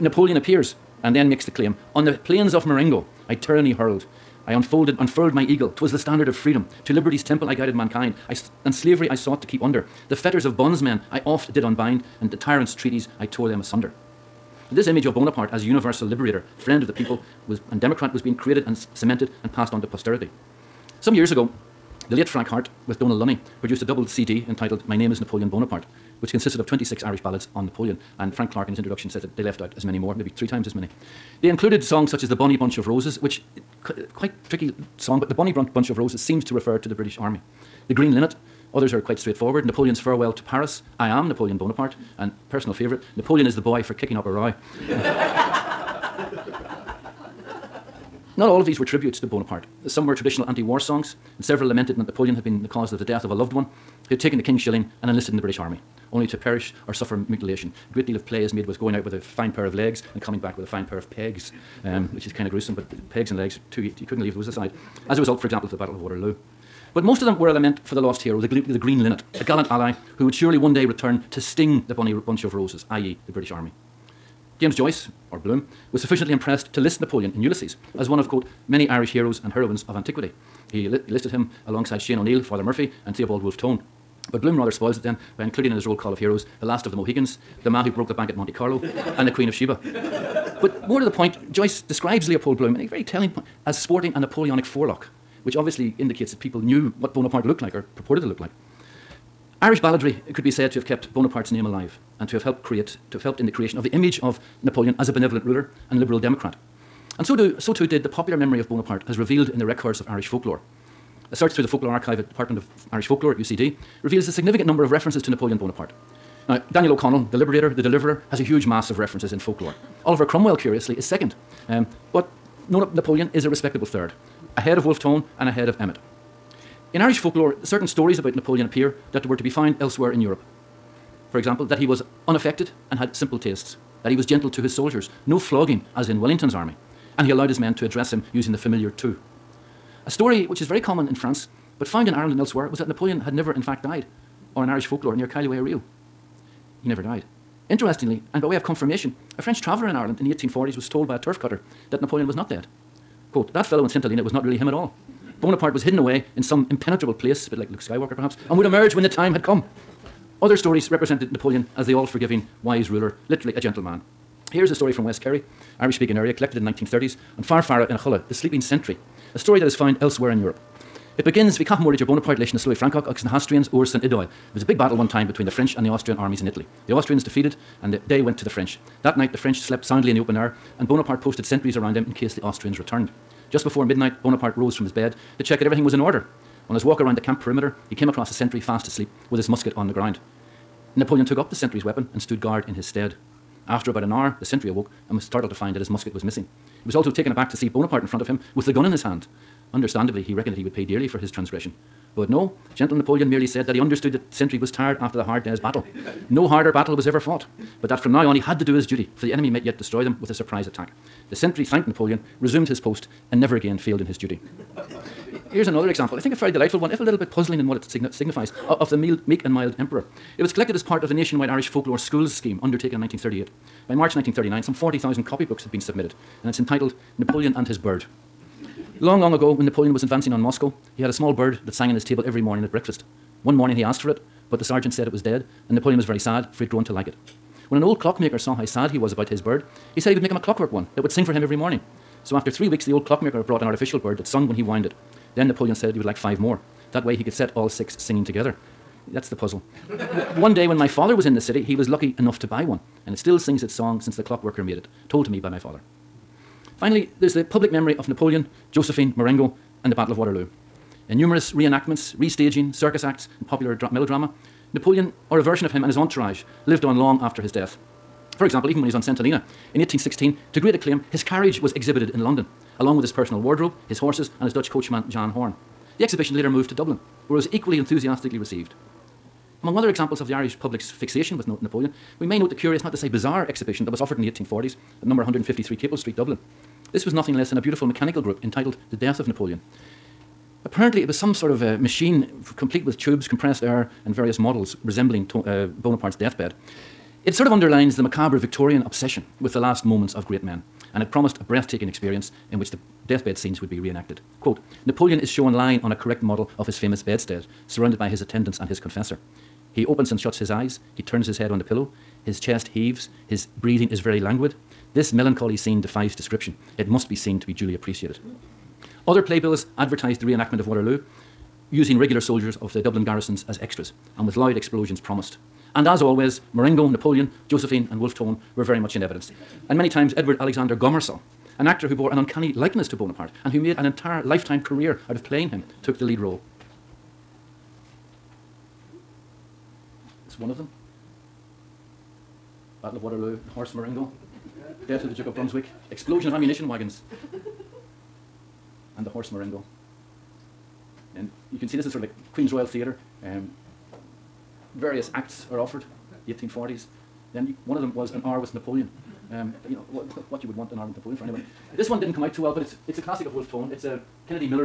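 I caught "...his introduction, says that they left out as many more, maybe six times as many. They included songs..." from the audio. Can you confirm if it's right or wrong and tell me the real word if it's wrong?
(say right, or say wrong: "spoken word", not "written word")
wrong: "three", not "six".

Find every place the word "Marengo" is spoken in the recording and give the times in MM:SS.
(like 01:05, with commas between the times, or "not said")
00:02, 04:19, 05:26, 05:43, 05:49.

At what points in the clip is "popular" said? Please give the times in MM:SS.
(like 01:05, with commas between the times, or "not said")
01:48, 04:23.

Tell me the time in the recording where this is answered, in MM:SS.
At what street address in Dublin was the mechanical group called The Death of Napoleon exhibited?
04:45.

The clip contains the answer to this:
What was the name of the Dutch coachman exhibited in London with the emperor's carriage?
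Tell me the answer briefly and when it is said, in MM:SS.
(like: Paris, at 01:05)
Jan Horn, at 04:35.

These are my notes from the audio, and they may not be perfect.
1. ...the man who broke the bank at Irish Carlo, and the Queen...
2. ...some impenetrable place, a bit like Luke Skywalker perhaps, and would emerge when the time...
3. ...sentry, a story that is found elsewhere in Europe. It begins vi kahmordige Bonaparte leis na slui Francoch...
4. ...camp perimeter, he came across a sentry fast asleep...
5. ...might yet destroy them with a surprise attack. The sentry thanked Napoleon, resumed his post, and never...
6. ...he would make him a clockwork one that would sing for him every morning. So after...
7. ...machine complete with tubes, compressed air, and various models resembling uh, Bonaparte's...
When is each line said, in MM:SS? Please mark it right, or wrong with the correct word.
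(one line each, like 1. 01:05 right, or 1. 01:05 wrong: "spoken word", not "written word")
1. 01:27 wrong: "Monte", not "Irish"
2. 02:36 right
3. 02:48 right
4. 03:07 right
5. 03:29 right
6. 04:00 right
7. 04:51 right.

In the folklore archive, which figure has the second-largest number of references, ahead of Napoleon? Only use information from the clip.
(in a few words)
Oliver Cromwell.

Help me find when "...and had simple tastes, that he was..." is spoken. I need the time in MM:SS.
02:12.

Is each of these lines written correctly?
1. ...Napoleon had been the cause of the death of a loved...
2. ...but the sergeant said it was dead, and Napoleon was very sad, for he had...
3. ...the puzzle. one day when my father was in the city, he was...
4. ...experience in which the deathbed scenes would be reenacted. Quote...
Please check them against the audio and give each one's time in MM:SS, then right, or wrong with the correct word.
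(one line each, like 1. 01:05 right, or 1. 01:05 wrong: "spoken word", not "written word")
1. 00:52 right
2. 03:54 right
3. 04:09 right
4. 05:01 right.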